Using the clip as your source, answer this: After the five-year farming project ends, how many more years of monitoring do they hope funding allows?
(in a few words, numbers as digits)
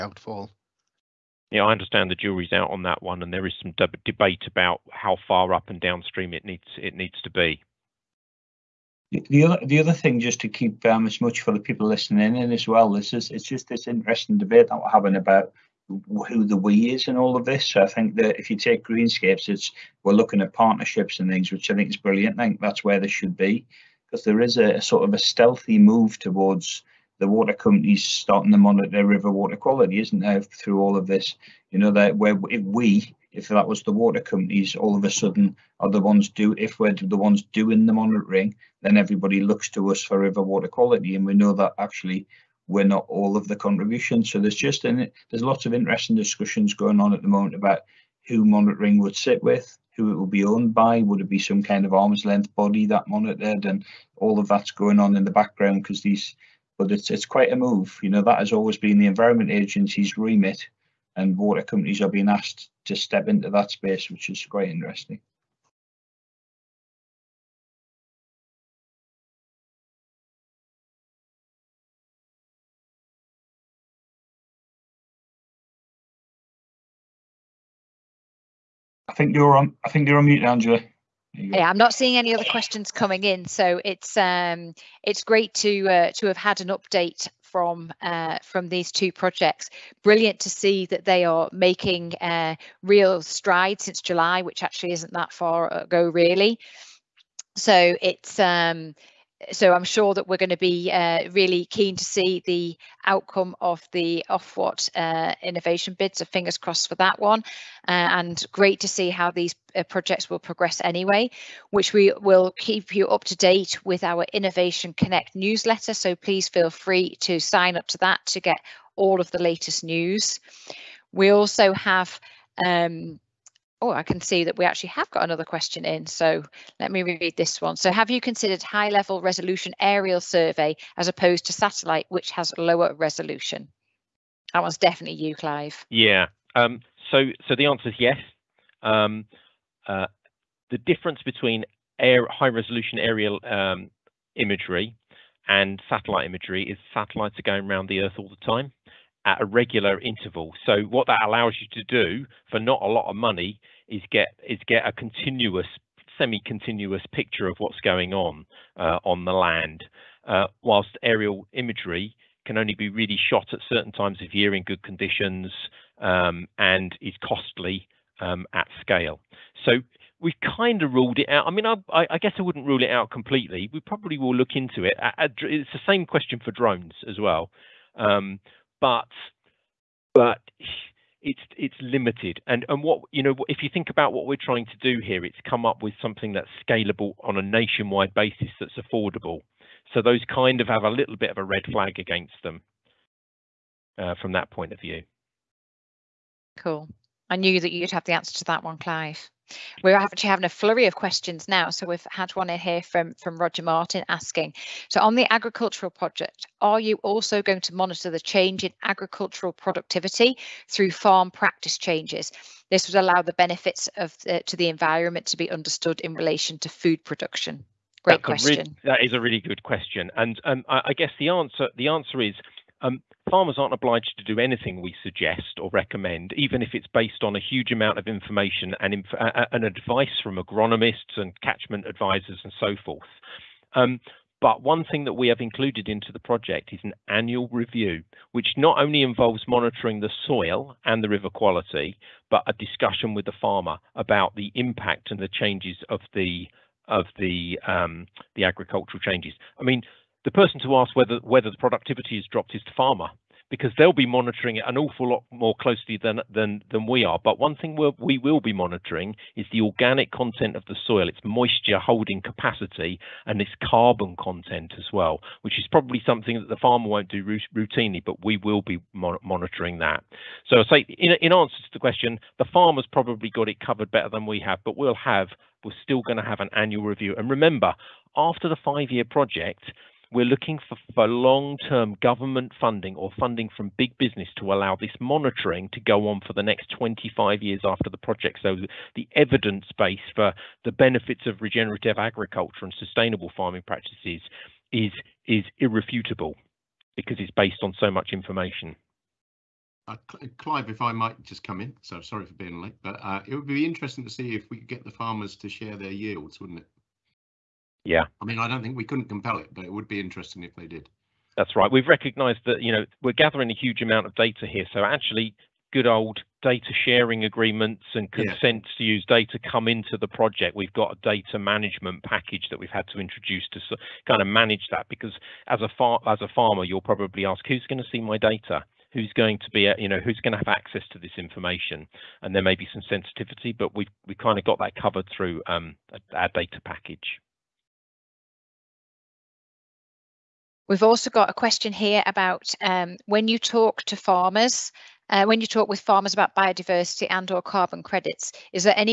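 25 years.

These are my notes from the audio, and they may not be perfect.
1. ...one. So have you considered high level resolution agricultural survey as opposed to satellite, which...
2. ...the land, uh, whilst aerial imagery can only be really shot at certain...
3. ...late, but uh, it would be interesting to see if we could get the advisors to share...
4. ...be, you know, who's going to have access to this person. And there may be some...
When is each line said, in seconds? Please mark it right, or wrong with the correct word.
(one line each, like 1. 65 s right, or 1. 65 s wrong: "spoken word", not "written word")
1. 127 s wrong: "aerial", not "agricultural"
2. 159 s right
3. 302 s wrong: "farmers", not "advisors"
4. 329 s wrong: "information", not "person".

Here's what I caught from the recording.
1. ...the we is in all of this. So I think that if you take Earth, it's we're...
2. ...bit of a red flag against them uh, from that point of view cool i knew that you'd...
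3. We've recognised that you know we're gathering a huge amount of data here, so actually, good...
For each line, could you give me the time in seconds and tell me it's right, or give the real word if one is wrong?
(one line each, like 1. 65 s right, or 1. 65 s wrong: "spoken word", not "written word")
1. 16 s wrong: "Greenscapes", not "Earth"
2. 191 s right
3. 311 s right.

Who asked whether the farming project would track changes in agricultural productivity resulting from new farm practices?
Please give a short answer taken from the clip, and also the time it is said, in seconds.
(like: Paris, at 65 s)
Roger Martin, at 203 s.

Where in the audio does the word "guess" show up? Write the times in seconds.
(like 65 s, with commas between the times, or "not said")
172 s, 220 s.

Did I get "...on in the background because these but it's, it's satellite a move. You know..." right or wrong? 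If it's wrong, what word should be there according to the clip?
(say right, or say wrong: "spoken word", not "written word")
wrong: "quite", not "satellite".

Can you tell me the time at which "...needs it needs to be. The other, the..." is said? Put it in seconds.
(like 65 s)
6 s.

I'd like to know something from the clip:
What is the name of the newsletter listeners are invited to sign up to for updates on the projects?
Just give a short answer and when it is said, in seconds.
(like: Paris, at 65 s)
Innovation Connect, at 114 s.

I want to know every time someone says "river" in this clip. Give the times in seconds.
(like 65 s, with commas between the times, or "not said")
29 s, 40 s, 241 s.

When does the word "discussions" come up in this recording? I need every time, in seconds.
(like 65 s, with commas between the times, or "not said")
46 s, 242 s.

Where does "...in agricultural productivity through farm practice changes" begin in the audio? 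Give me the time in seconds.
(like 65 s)
208 s.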